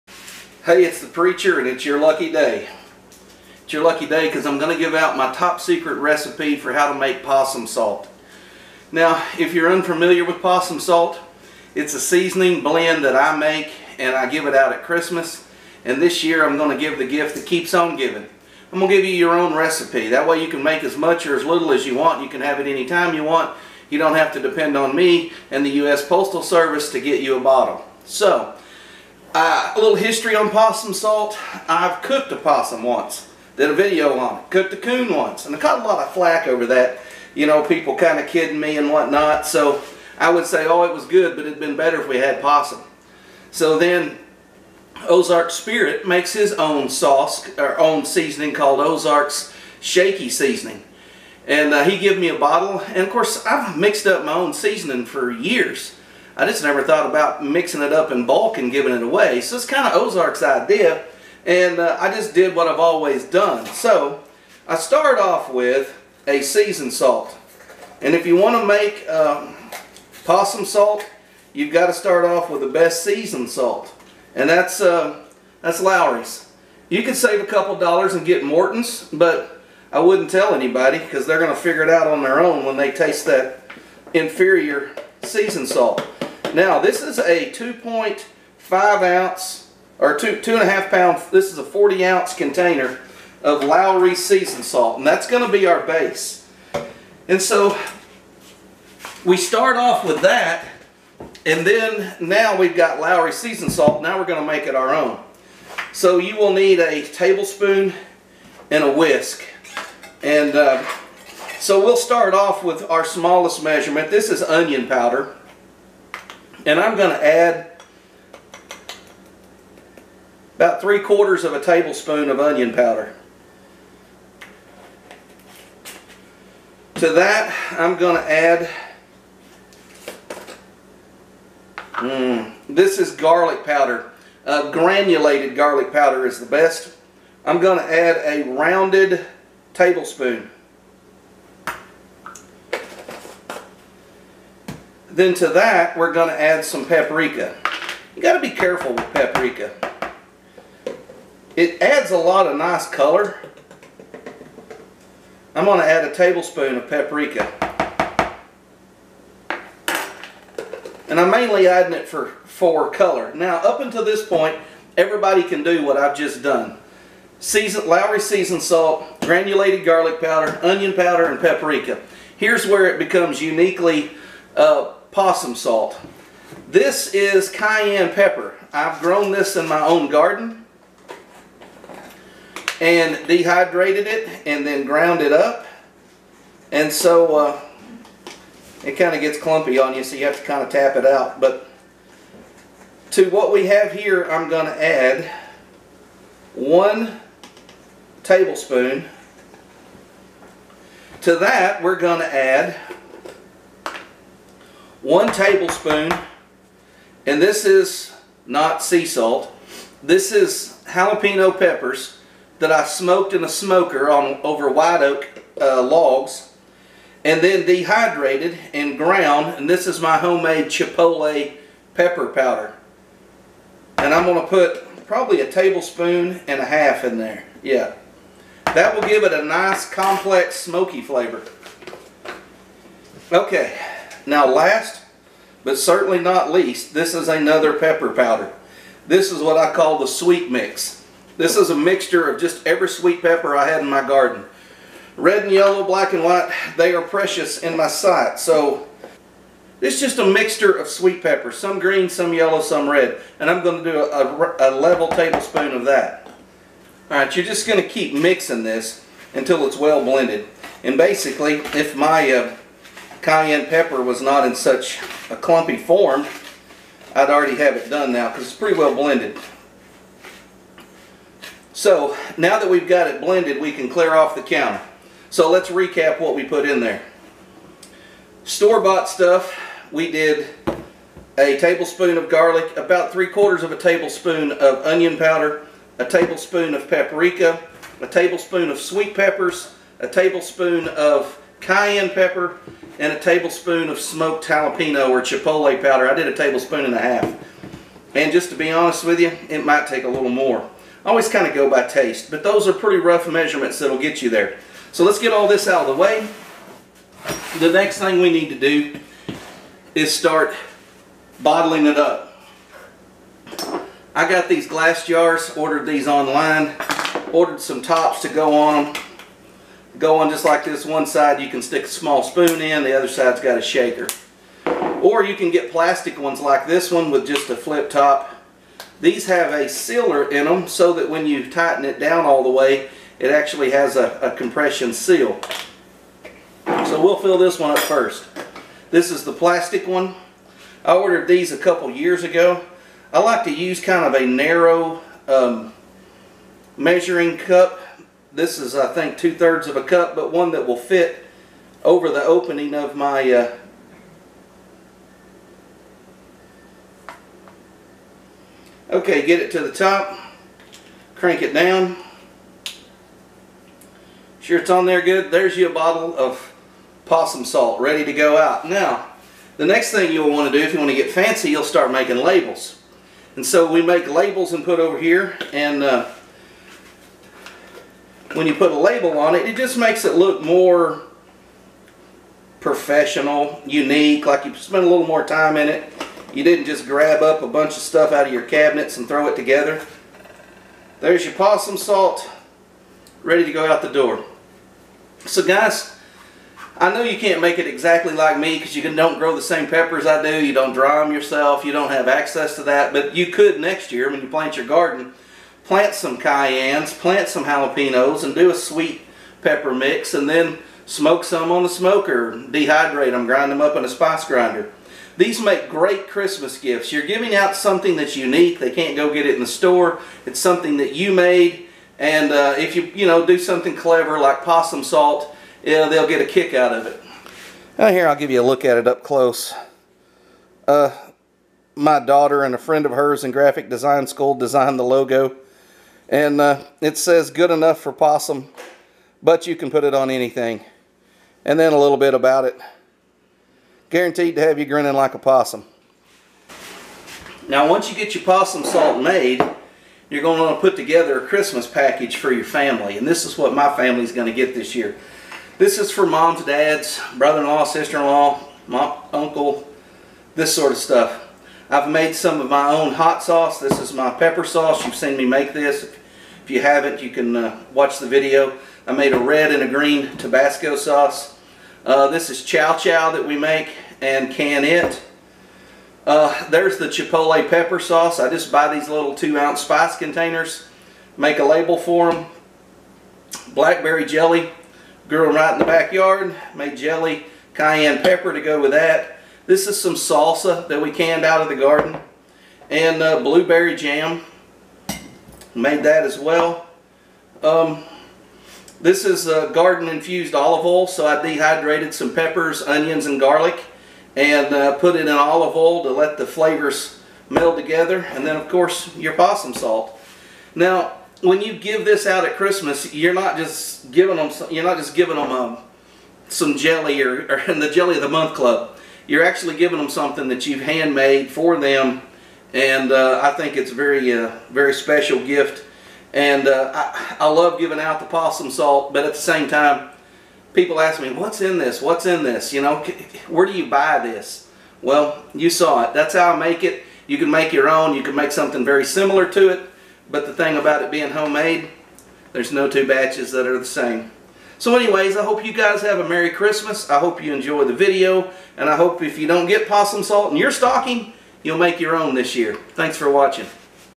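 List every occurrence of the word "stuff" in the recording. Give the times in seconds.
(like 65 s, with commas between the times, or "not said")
279 s, 387 s, 460 s.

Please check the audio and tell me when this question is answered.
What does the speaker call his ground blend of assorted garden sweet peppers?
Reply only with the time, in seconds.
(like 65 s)
239 s.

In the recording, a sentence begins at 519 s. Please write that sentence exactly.
You're actually giving them something that you've handmade for them and uh, I think it's a very, uh, very special gift.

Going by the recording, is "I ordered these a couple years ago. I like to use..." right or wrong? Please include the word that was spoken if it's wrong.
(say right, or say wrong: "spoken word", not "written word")
right.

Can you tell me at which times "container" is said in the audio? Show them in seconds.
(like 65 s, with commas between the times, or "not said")
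92 s, 479 s.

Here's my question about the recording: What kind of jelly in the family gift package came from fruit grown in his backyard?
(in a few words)
Blackberry jelly.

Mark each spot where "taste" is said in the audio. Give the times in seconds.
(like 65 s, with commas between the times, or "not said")
82 s, 301 s.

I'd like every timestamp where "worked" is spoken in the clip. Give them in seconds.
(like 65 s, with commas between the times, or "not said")
not said.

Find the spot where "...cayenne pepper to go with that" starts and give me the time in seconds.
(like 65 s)
487 s.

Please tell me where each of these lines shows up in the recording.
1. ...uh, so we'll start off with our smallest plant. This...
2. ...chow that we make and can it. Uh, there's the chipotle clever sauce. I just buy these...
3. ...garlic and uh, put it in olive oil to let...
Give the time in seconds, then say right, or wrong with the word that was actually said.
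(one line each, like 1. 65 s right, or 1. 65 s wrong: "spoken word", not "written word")
1. 110 s wrong: "measurement", not "plant"
2. 472 s wrong: "pepper", not "clever"
3. 503 s right.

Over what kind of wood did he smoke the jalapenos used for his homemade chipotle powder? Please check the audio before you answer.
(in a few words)
white oak.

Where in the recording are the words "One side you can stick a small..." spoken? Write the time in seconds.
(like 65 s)
320 s.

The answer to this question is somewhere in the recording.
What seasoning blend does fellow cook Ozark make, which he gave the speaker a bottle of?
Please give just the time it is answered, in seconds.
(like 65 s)
48 s.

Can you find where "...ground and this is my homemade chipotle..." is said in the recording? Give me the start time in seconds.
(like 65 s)
218 s.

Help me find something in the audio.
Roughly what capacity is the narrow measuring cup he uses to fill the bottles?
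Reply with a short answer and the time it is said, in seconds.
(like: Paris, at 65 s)
two-thirds of a cup, at 349 s.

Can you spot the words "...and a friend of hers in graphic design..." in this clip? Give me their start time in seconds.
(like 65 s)
432 s.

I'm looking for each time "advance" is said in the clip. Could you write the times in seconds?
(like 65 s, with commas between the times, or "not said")
not said.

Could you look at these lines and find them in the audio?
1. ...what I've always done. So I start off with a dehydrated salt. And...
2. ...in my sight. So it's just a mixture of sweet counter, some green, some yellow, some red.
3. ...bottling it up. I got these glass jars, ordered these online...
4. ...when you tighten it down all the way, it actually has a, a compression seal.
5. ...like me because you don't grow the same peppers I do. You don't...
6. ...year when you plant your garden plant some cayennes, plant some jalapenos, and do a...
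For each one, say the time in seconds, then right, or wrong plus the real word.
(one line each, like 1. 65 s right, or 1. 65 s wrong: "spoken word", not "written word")
1. 62 s wrong: "seasoned", not "dehydrated"
2. 247 s wrong: "pepper", not "counter"
3. 311 s right
4. 331 s right
5. 398 s right
6. 403 s right.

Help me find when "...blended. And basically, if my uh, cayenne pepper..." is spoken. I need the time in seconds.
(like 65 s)
260 s.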